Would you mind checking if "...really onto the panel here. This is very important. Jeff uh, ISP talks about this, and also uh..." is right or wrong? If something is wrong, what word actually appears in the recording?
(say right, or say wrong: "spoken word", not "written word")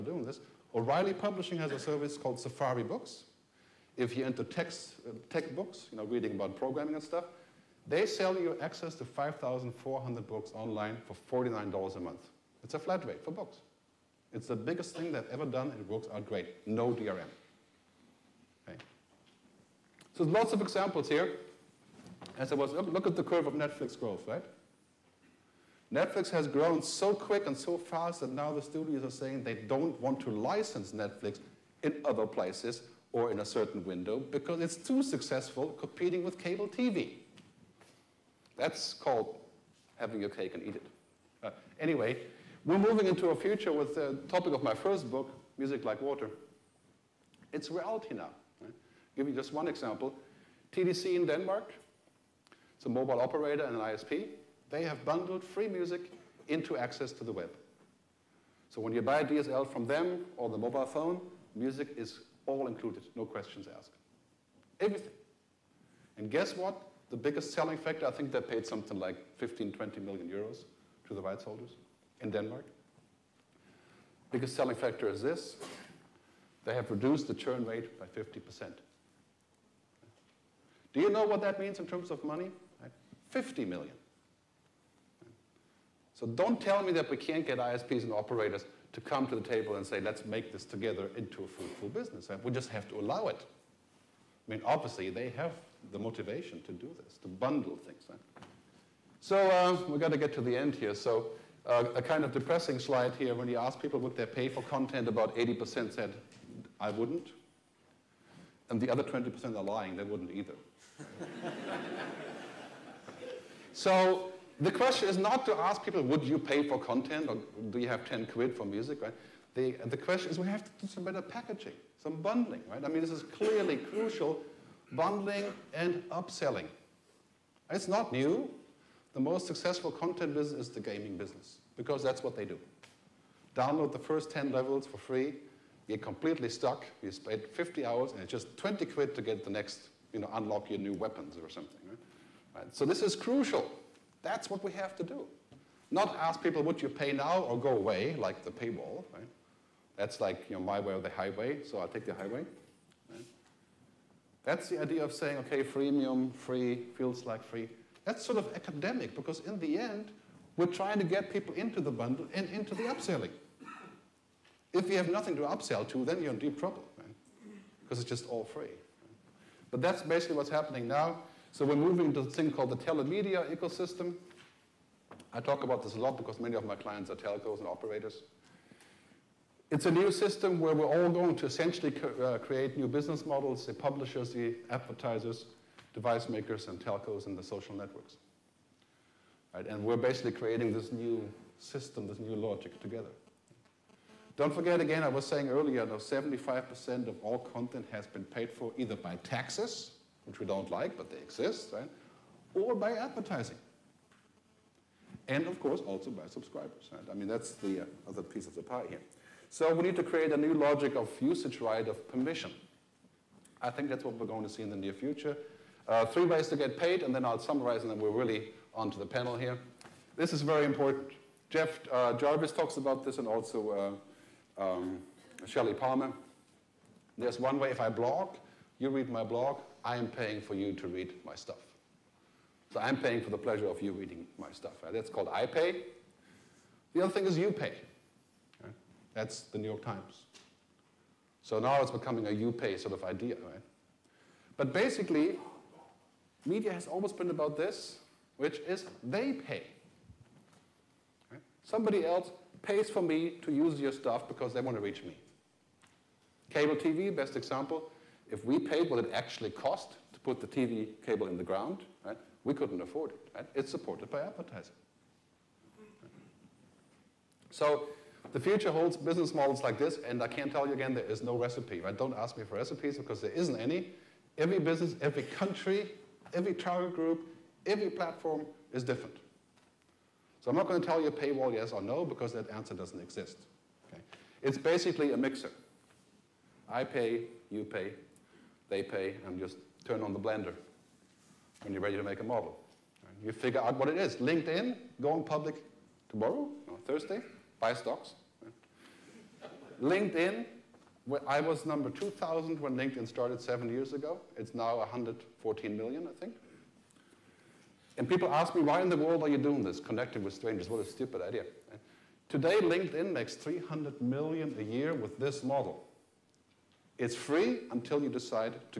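wrong: "Jarvis", not "ISP".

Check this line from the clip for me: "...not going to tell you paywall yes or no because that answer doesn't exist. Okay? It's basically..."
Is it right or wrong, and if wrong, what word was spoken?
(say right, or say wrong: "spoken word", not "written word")
right.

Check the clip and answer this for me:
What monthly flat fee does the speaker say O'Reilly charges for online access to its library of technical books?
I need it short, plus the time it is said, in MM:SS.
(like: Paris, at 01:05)
$49, at 00:11.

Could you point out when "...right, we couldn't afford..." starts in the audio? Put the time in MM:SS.
04:22.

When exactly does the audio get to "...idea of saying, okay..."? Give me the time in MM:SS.
02:34.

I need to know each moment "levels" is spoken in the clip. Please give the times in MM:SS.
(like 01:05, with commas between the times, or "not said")
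02:14.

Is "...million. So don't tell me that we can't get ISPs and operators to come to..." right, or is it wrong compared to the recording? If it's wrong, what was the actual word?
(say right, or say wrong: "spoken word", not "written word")
right.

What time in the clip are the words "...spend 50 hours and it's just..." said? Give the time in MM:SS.
02:17.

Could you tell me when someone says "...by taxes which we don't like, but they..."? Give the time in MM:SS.
03:18.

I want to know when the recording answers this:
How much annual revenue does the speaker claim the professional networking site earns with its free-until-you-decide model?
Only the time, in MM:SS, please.
05:13.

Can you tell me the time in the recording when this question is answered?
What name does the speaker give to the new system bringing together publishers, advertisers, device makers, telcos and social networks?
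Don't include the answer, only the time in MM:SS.
02:52.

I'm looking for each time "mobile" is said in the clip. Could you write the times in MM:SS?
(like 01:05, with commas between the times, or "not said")
00:52, 01:00.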